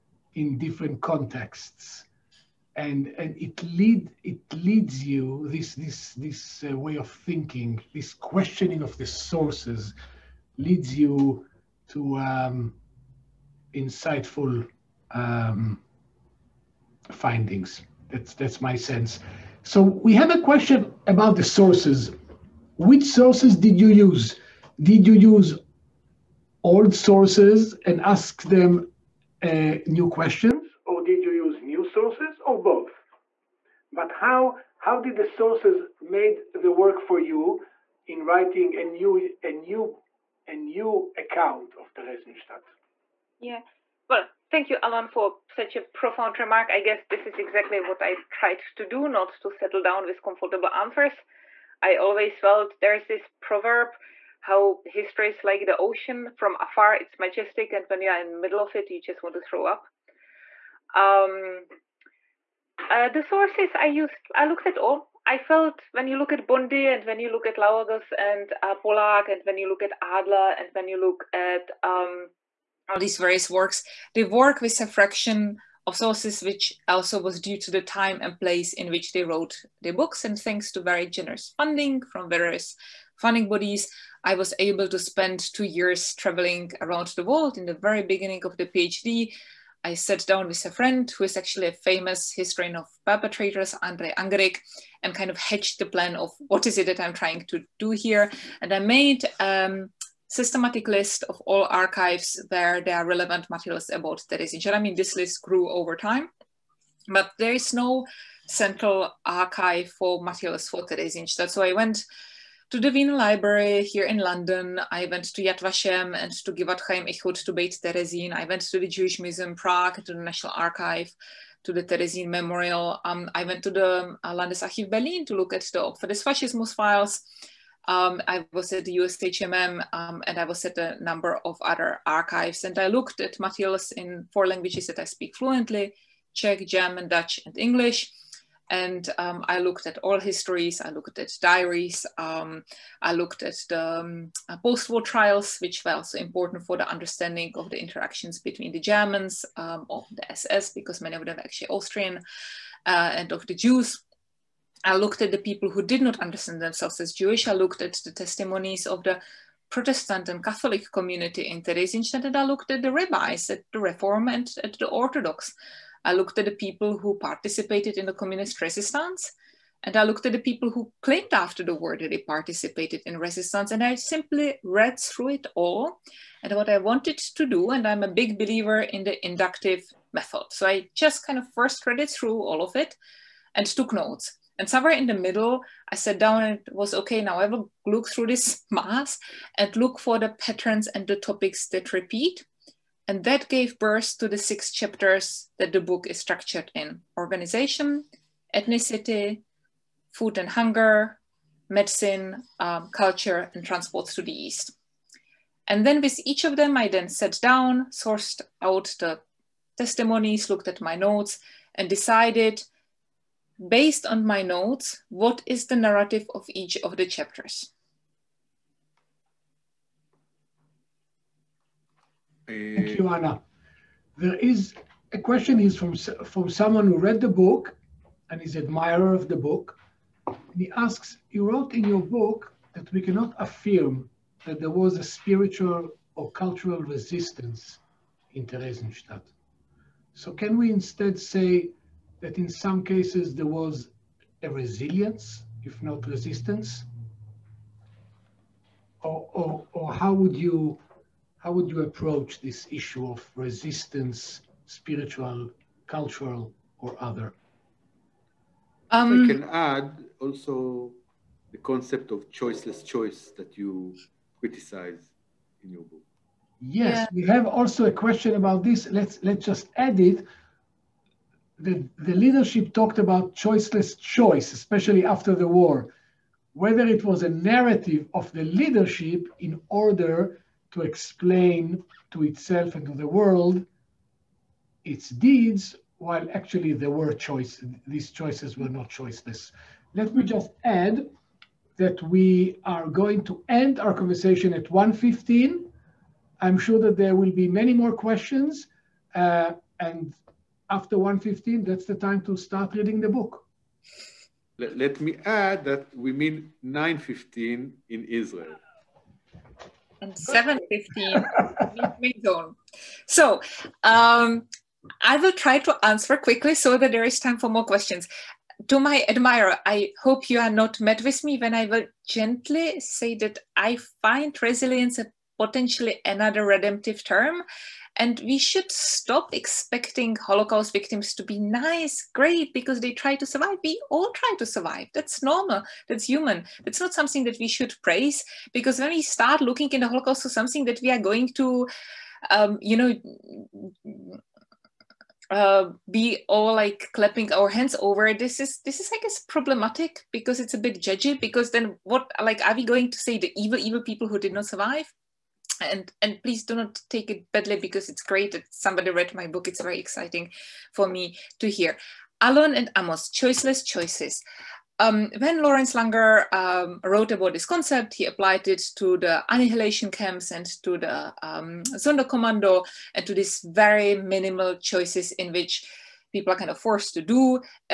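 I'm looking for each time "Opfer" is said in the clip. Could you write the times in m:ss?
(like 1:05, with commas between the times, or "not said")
2:05.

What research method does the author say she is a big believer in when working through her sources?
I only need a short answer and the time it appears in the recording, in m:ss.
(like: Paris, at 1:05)
inductive method, at 2:59.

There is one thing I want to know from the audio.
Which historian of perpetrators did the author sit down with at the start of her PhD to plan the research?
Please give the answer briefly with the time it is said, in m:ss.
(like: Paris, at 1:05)
Andrej Angrick, at 1:33.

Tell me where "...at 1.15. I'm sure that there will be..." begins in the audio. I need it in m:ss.
4:54.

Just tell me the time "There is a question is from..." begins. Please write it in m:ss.
3:44.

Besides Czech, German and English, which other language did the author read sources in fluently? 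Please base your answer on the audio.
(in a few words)
Dutch.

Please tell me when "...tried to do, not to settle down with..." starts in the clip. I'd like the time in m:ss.
0:48.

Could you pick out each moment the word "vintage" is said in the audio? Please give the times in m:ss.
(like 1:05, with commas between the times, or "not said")
not said.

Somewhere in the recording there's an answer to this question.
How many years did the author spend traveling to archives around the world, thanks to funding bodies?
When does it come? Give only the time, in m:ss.
1:25.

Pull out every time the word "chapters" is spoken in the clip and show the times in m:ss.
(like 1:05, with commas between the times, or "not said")
3:14, 3:37.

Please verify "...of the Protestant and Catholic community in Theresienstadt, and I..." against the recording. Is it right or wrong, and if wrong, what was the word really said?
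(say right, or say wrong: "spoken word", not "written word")
right.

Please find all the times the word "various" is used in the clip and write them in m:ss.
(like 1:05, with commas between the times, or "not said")
1:13, 1:22.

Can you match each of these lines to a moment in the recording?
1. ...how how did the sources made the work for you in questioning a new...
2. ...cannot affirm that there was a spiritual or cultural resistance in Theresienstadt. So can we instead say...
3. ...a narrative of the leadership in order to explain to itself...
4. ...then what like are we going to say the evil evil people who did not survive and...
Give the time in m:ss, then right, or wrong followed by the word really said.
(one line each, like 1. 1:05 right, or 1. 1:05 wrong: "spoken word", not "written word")
1. 0:34 wrong: "writing", not "questioning"
2. 3:53 right
3. 4:37 right
4. 5:51 right.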